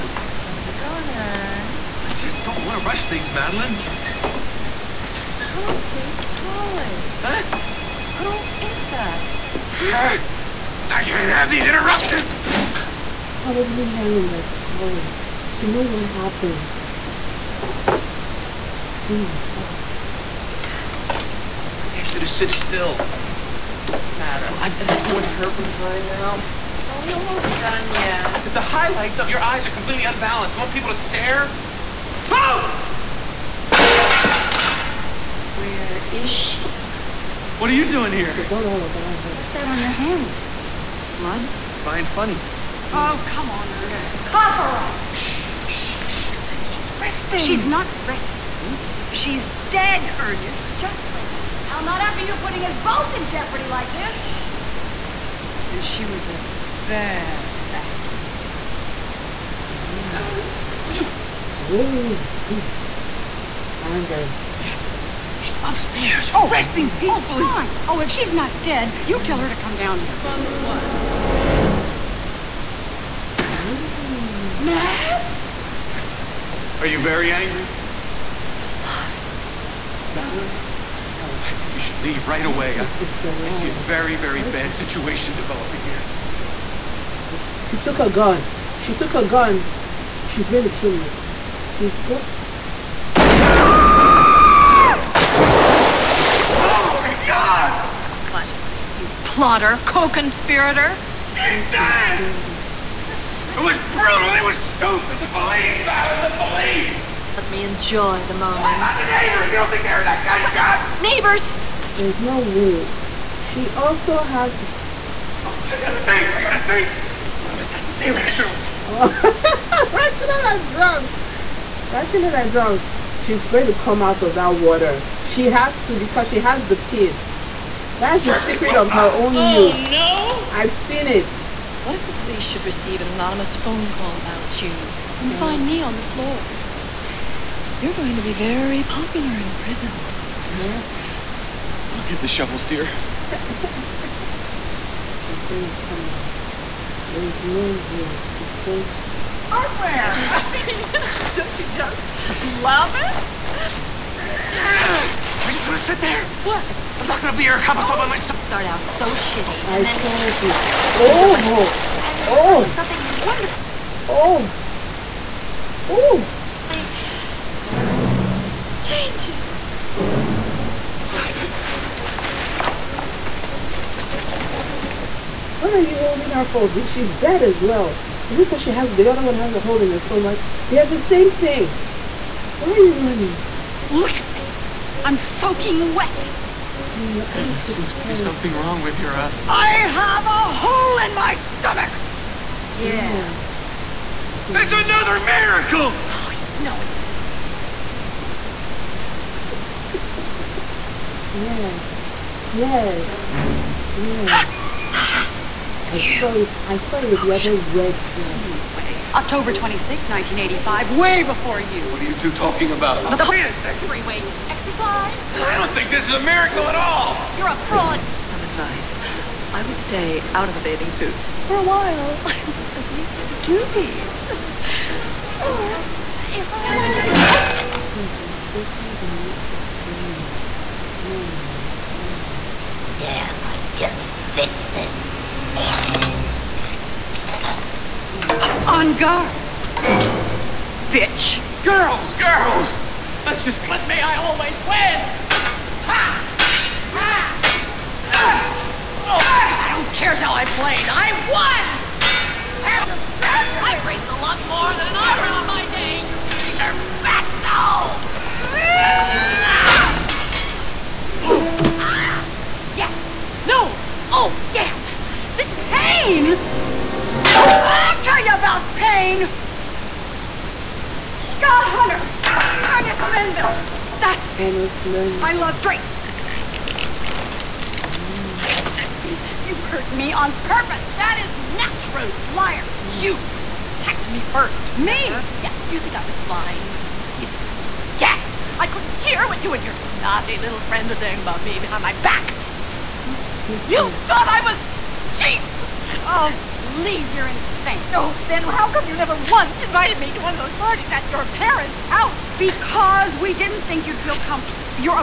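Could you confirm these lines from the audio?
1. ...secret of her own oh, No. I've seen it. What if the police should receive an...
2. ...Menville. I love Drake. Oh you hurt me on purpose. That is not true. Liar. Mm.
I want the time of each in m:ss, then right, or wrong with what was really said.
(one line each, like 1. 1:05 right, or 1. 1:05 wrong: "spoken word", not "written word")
1. 2:08 right
2. 4:34 right.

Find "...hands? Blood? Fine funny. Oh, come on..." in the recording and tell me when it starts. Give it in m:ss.
0:39.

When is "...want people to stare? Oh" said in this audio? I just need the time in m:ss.
0:30.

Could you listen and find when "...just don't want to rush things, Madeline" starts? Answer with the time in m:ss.
0:02.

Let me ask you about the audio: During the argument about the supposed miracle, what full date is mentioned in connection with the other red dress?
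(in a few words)
October 26, 1985.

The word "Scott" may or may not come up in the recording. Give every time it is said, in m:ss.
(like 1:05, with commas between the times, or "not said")
4:31.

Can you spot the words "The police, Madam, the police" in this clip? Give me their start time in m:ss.
1:45.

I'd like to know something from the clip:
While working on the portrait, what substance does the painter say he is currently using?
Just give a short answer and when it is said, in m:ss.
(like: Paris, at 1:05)
turpentine, at 0:25.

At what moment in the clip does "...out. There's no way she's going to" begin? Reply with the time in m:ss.
2:26.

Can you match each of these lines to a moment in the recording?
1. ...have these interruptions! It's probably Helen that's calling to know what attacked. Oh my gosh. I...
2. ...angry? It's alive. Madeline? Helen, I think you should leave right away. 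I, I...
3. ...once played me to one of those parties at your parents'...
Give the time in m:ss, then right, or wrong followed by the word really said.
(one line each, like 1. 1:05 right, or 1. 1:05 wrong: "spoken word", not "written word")
1. 0:11 wrong: "happened", not "attacked"
2. 1:17 right
3. 4:59 wrong: "invited", not "played".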